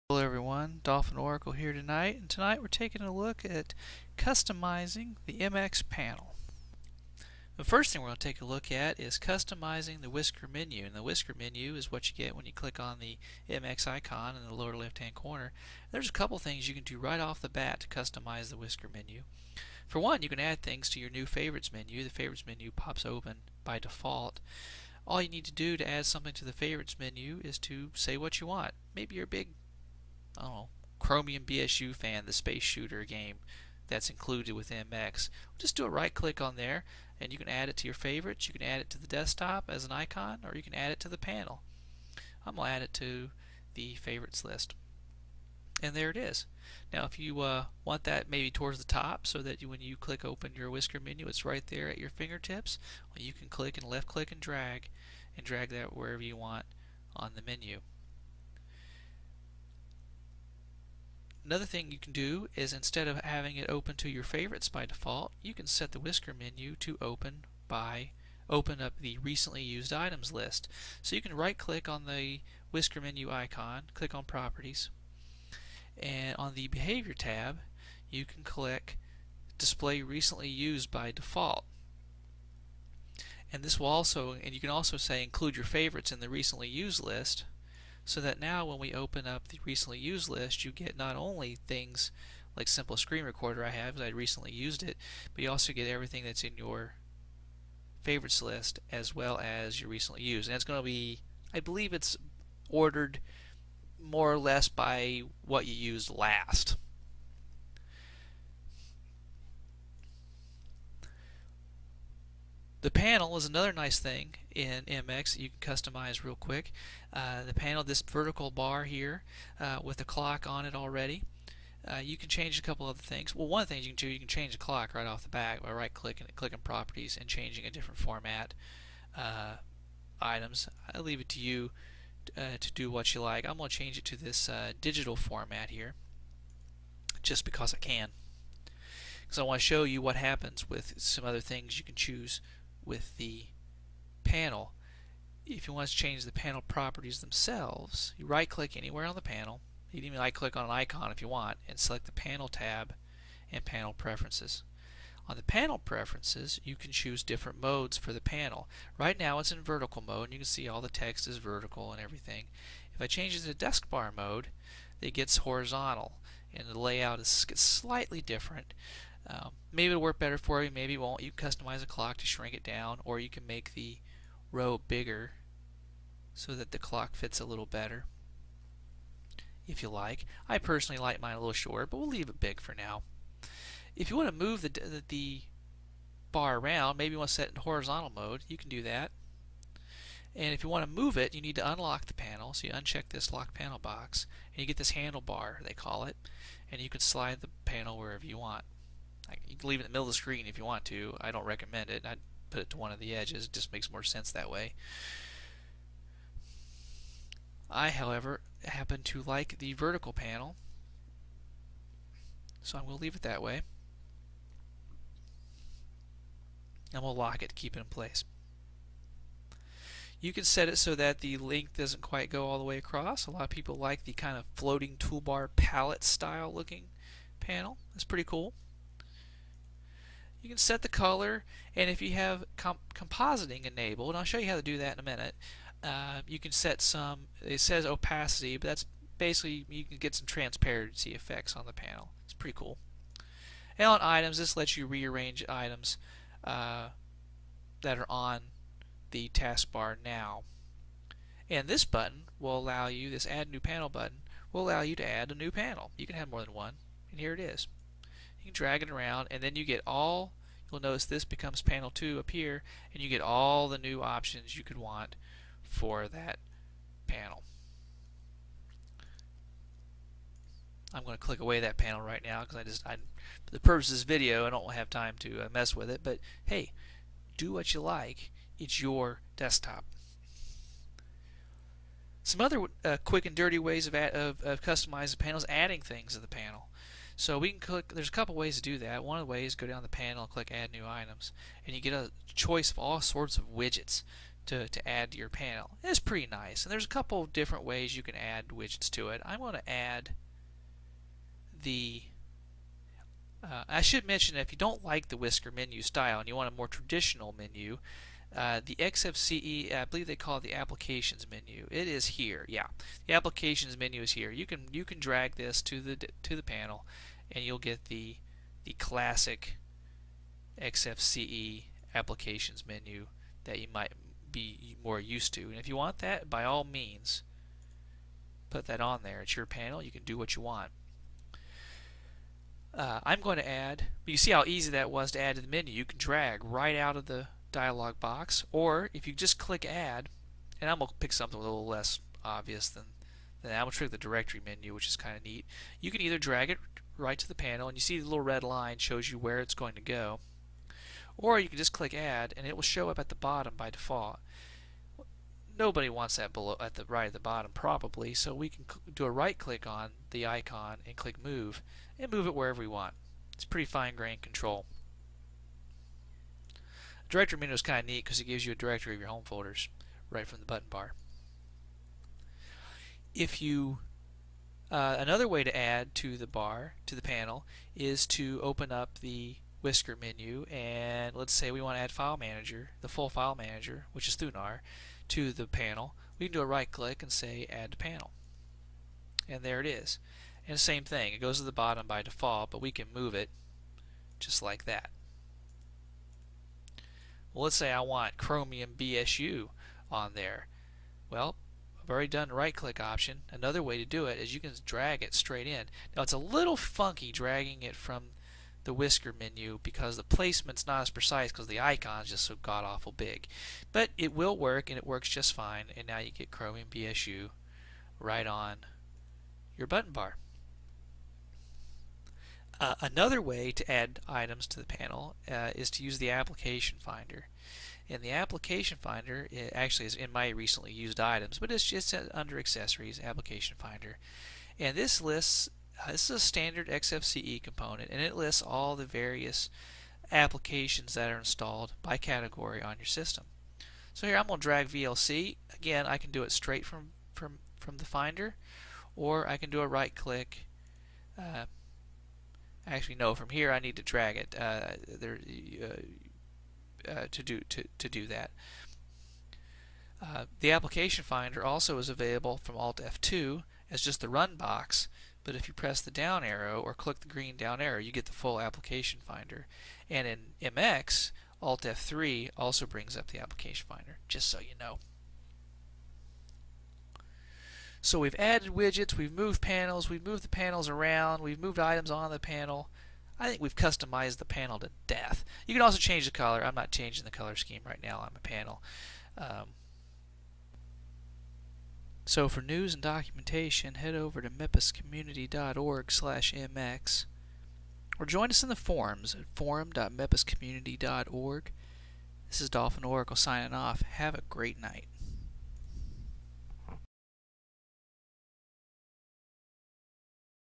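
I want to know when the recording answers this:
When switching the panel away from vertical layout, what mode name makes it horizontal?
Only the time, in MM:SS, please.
02:43.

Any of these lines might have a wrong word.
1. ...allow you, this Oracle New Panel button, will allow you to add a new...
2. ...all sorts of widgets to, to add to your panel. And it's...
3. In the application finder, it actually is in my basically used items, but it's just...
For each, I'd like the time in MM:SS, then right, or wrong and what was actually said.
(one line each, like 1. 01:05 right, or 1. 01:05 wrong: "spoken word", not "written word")
1. 04:12 wrong: "Add", not "Oracle"
2. 04:52 right
3. 07:07 wrong: "recently", not "basically".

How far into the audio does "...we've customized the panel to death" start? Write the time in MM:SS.
08:03.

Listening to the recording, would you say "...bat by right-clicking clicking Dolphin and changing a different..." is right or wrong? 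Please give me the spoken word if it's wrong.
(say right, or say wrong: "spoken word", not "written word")
wrong: "Properties", not "Dolphin".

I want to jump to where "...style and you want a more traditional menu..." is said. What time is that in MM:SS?
05:05.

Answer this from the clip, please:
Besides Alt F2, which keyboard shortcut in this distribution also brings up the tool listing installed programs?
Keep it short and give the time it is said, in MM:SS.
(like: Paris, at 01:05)
Alt F3, at 07:51.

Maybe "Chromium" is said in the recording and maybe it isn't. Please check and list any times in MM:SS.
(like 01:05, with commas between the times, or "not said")
00:30, 06:38, 06:56.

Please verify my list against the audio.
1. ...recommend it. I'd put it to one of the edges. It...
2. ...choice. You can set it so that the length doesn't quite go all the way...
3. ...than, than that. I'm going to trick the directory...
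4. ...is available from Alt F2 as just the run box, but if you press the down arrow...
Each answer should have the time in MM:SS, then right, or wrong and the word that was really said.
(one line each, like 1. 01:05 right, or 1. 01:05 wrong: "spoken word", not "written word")
1. 03:21 right
2. 03:37 wrong: "place", not "choice"
3. 05:42 right
4. 07:41 right.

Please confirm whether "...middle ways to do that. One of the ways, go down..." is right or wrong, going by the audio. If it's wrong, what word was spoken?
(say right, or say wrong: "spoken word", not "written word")
wrong: "couple", not "middle".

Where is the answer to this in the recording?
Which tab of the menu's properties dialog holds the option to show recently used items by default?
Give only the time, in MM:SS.
01:16.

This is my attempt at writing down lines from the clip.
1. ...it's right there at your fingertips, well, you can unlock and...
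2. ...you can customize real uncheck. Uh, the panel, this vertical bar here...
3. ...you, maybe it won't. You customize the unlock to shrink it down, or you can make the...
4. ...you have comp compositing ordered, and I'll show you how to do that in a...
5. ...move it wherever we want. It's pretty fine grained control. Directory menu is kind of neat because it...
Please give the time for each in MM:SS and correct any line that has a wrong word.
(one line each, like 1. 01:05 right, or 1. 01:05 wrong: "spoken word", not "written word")
1. 00:51 wrong: "click", not "unlock"
2. 01:55 wrong: "quick", not "uncheck"
3. 02:50 wrong: "clock", not "unlock"
4. 03:52 wrong: "enabled", not "ordered"
5. 06:02 right.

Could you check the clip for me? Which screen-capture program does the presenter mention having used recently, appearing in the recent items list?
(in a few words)
simple screen recorder.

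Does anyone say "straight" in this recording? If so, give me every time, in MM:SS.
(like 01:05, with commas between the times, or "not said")
06:45, 07:26.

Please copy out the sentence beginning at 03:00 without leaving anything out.
I personally like mine a little shorter, but we'll leave it big for now.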